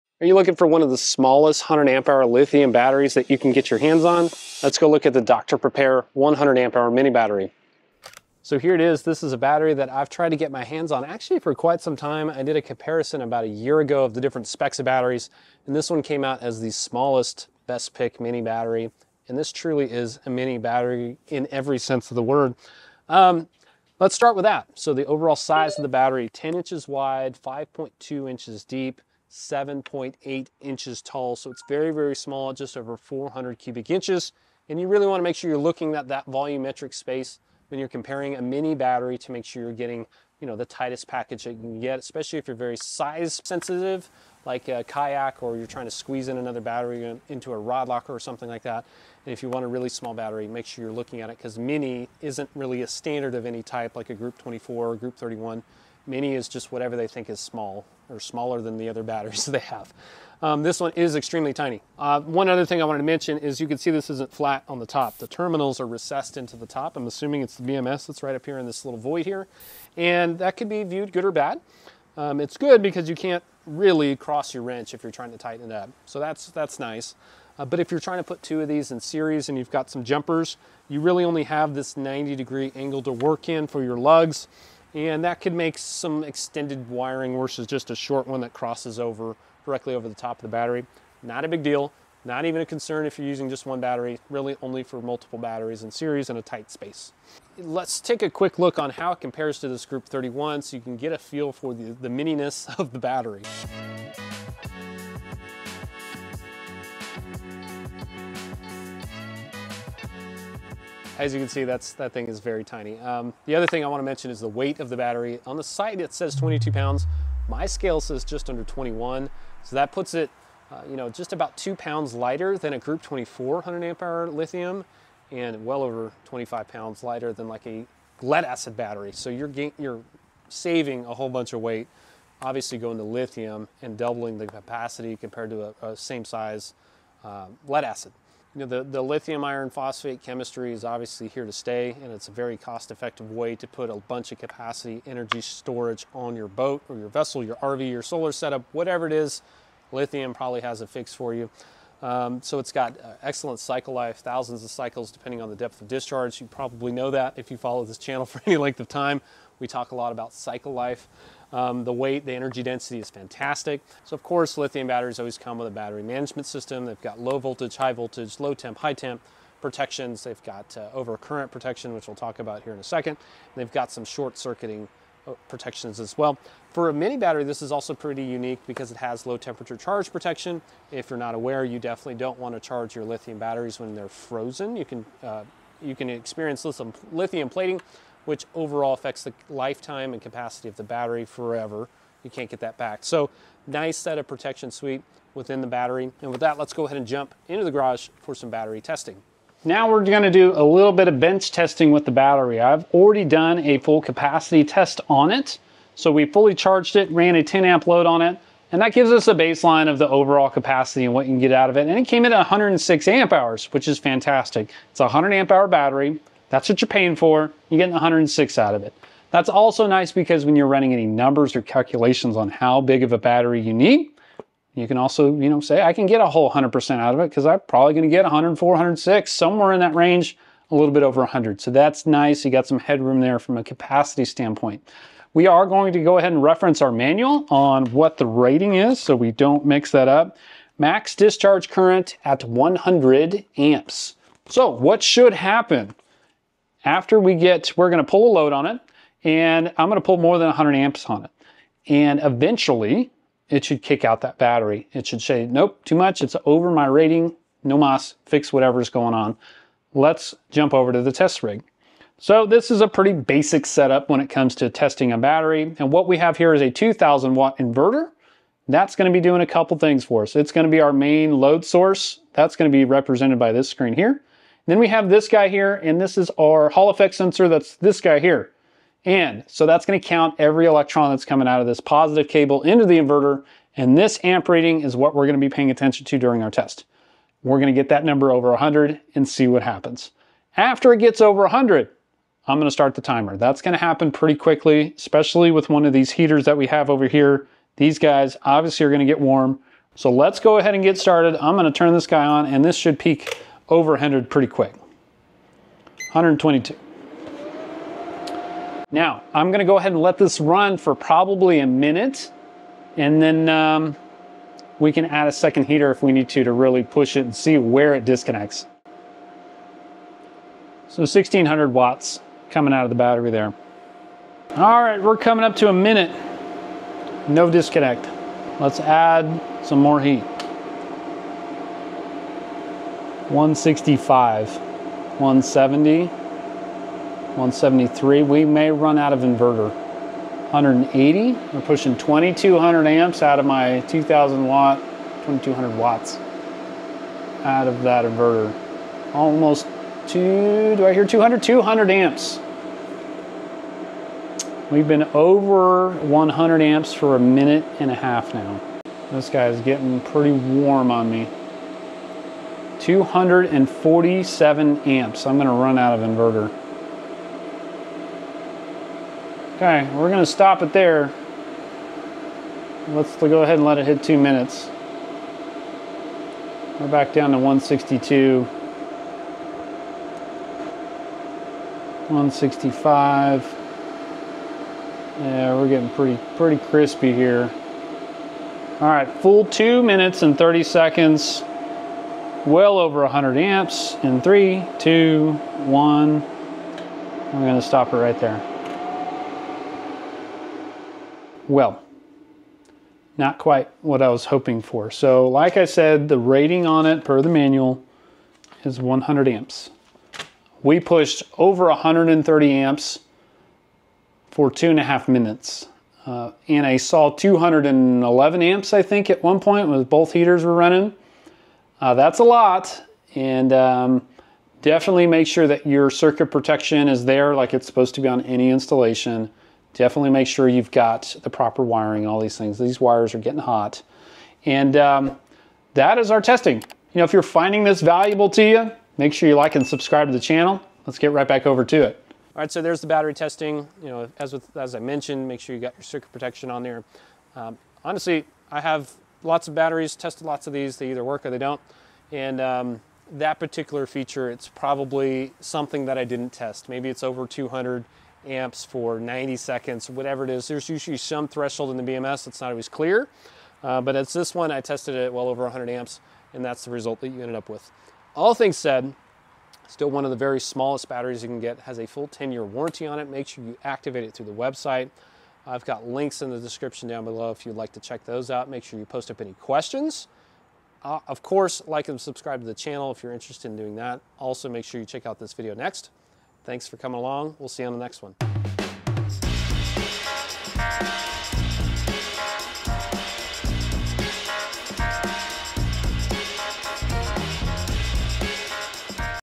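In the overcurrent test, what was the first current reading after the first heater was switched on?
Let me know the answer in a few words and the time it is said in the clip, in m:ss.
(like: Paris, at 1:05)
122, at 5:06.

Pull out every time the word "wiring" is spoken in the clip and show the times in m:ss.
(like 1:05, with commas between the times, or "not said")
1:26, 7:11.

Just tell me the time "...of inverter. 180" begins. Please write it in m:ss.
5:39.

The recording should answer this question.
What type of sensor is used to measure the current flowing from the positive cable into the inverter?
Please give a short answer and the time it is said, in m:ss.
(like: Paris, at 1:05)
Hall effect sensor, at 4:36.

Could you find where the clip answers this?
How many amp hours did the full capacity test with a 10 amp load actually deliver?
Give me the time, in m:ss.
3:32.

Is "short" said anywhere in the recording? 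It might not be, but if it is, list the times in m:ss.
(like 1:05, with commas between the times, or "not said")
1:27, 2:54.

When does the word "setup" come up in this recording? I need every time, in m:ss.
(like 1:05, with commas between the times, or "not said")
2:28, 4:23.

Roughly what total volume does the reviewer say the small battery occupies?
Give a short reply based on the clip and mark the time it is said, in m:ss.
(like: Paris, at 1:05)
just over 400 cubic inches, at 0:32.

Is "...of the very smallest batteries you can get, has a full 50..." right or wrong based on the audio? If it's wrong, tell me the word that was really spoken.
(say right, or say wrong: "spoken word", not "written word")
wrong: "10", not "50".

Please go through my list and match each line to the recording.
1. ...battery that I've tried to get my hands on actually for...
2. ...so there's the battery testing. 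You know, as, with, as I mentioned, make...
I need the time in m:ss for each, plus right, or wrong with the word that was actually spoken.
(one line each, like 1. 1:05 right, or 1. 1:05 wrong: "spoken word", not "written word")
1. 0:09 right
2. 7:22 right.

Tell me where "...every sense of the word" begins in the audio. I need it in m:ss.
0:21.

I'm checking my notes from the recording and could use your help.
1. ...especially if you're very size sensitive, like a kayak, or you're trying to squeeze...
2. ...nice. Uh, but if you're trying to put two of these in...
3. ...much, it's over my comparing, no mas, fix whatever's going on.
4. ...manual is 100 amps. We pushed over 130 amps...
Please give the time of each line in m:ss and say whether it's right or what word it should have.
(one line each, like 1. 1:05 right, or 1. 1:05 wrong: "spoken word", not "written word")
1. 0:41 right
2. 1:16 right
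3. 4:15 wrong: "rating", not "comparing"
4. 6:47 right.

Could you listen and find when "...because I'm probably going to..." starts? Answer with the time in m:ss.
3:47.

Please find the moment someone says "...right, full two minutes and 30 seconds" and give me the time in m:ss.
6:28.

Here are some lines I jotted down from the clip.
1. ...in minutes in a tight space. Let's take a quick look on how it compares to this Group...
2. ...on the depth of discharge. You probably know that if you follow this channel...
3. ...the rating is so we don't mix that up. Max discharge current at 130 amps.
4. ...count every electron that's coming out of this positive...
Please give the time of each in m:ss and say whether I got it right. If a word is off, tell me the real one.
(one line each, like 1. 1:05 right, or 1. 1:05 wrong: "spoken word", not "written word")
1. 1:35 wrong: "series", not "minutes"
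2. 2:35 right
3. 3:58 wrong: "100", not "130"
4. 4:39 right.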